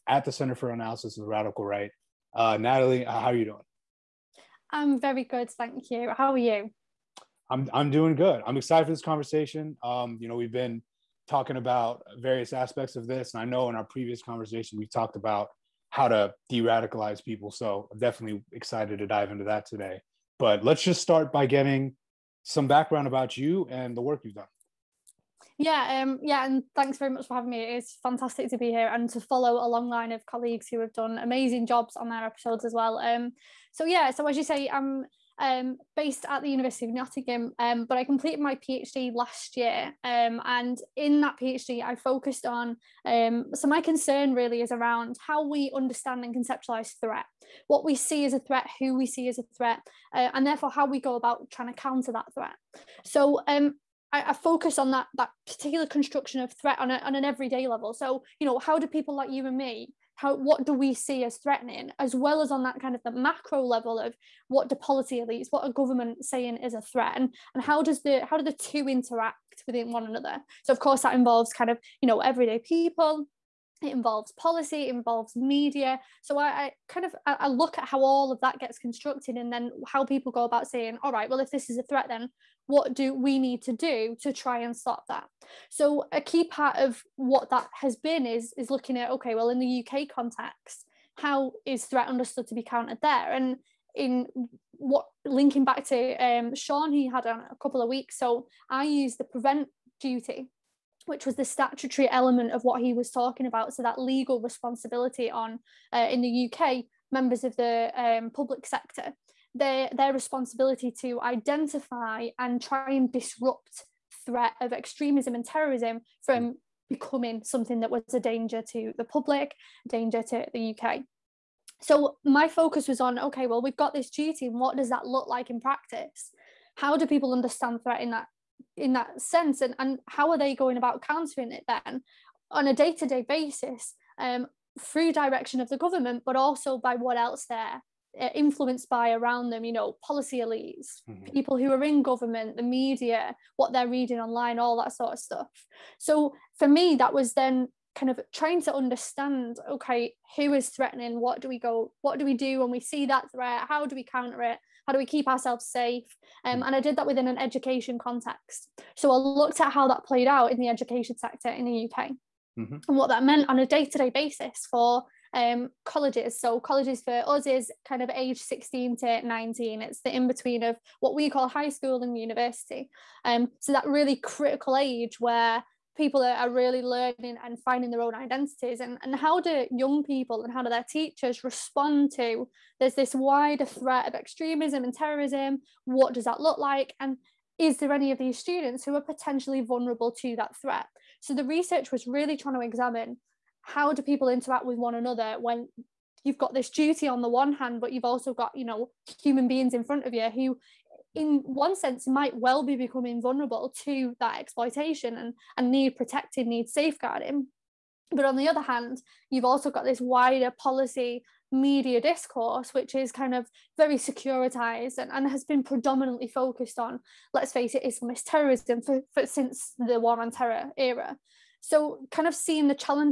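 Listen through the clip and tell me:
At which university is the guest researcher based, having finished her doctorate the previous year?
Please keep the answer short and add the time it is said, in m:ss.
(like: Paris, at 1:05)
University of Nottingham, at 0:36.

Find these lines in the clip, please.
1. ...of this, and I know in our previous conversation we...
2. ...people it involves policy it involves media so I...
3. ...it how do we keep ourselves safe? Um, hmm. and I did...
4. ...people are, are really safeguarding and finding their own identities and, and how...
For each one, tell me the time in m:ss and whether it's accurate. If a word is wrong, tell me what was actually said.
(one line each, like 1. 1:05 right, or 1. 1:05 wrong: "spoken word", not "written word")
1. 0:12 right
2. 1:12 right
3. 2:34 right
4. 2:55 wrong: "learning", not "safeguarding".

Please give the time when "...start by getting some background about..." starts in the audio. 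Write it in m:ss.
0:20.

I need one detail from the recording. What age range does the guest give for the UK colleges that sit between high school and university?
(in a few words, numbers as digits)
16 to 19.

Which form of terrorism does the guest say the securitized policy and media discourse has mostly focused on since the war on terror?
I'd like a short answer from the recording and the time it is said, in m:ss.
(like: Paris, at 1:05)
Islamist terrorism, at 3:37.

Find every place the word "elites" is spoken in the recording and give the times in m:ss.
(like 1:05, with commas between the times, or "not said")
1:05, 2:20.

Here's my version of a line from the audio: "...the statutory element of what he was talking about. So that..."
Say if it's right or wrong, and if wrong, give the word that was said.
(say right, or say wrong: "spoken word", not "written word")
right.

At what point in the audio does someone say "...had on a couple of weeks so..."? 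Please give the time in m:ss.
1:37.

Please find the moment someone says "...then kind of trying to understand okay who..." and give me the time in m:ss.
2:27.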